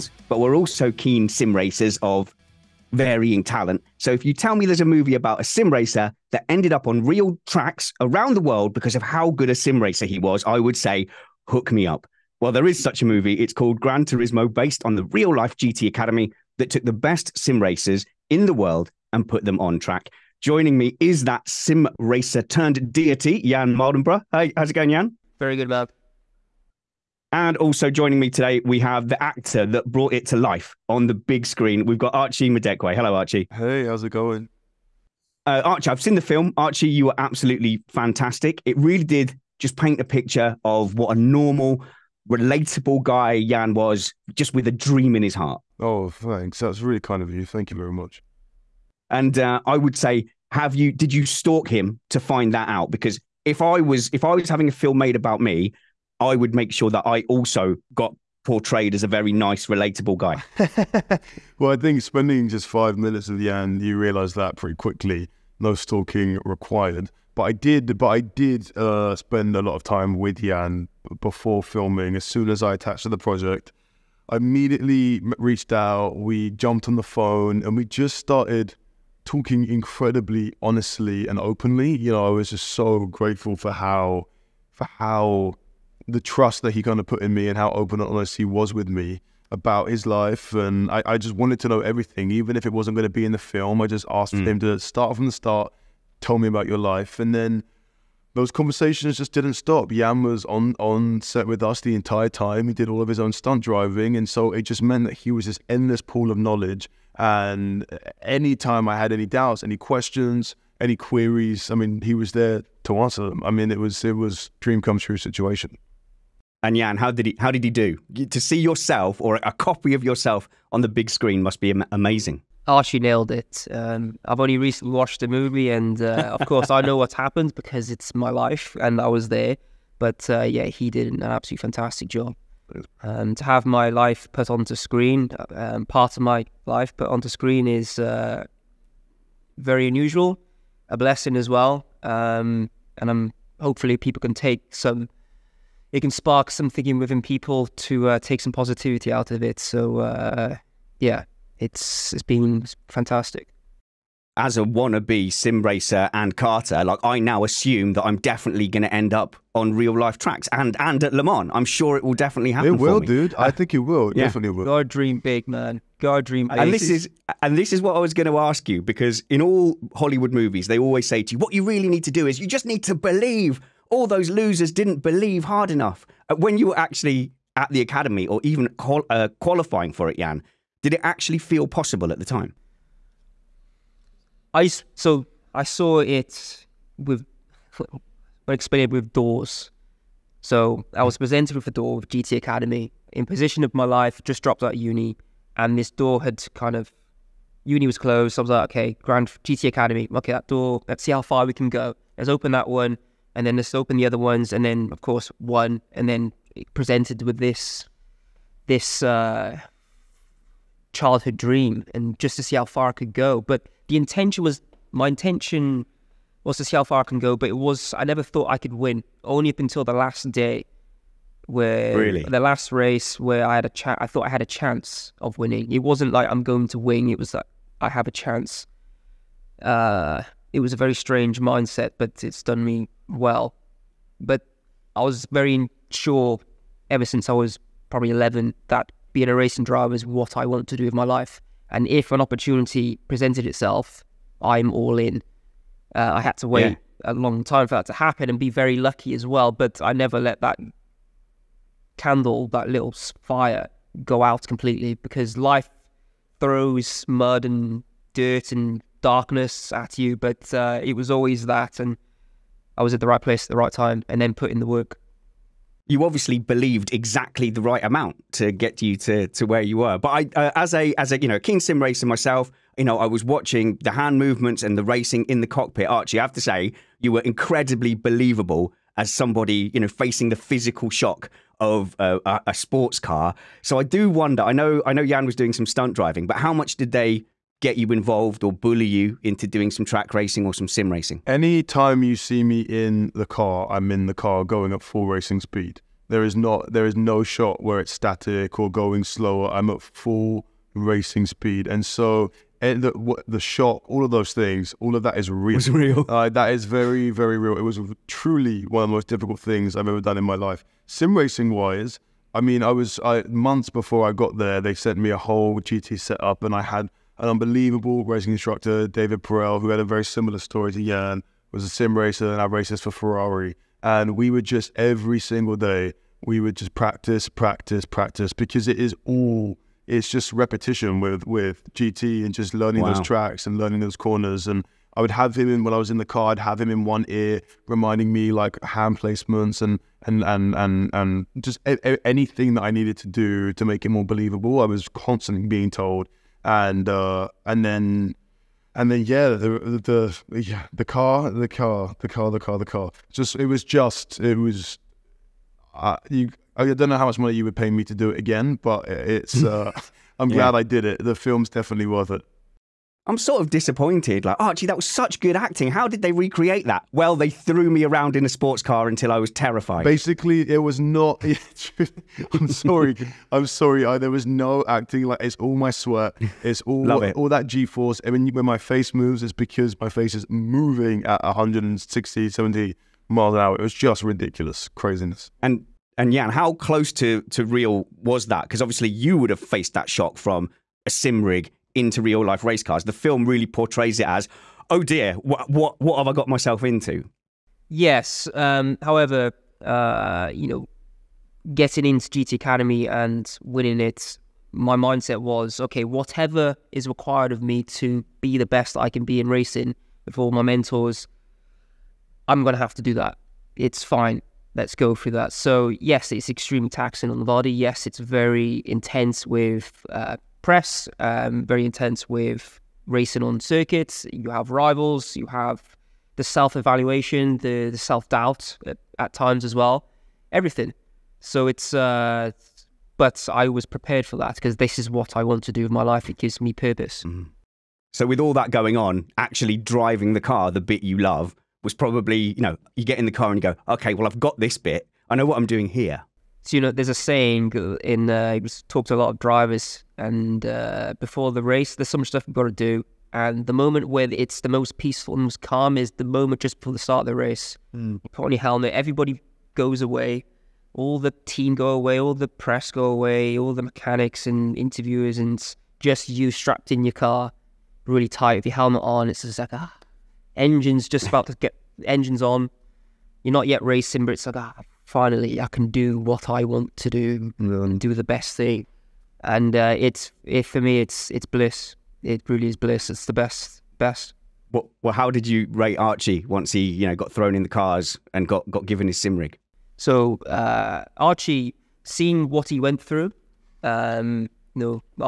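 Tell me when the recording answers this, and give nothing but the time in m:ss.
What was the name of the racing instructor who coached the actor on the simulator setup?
5:18.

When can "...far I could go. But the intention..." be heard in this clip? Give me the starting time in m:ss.
3:32.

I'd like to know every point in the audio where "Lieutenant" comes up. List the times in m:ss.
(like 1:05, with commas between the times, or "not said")
not said.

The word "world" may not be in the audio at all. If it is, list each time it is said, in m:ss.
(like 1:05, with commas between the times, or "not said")
0:08, 0:18.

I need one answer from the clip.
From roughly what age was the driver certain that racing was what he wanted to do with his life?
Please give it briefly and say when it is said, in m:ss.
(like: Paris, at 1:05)
11, at 3:58.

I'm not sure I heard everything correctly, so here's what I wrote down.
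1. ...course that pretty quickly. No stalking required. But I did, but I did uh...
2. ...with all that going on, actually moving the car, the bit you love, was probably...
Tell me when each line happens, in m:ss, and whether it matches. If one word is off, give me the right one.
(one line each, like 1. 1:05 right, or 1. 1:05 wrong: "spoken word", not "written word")
1. 1:03 wrong: "realise", not "course"
2. 7:18 wrong: "driving", not "moving".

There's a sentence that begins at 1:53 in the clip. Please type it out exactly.
I mean, it was it was dream come true situation.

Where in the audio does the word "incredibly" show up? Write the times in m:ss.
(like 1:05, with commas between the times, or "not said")
1:19, 4:37.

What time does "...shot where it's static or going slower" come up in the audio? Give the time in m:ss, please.
4:57.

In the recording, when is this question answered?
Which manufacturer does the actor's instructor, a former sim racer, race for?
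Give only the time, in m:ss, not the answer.
5:22.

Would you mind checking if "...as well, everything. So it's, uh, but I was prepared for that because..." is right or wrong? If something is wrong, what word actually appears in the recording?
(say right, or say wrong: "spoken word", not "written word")
right.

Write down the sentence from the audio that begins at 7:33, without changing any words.
And the moment where it's the most peaceful and most calm is the moment just before the start of the race.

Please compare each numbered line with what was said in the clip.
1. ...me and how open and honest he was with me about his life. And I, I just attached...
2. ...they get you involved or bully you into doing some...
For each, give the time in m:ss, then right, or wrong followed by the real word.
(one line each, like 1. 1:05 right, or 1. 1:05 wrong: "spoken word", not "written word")
1. 1:27 wrong: "wanted", not "attached"
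2. 4:46 right.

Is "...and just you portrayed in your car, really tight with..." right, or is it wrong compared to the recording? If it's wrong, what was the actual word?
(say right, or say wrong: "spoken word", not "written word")
wrong: "strapped", not "portrayed".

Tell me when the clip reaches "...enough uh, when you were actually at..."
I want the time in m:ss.
2:55.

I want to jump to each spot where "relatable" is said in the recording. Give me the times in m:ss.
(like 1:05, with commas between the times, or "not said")
0:42, 0:59.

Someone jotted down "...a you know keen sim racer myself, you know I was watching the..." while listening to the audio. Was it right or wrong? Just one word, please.
right.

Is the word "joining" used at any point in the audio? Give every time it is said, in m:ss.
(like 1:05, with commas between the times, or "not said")
0:20, 0:27.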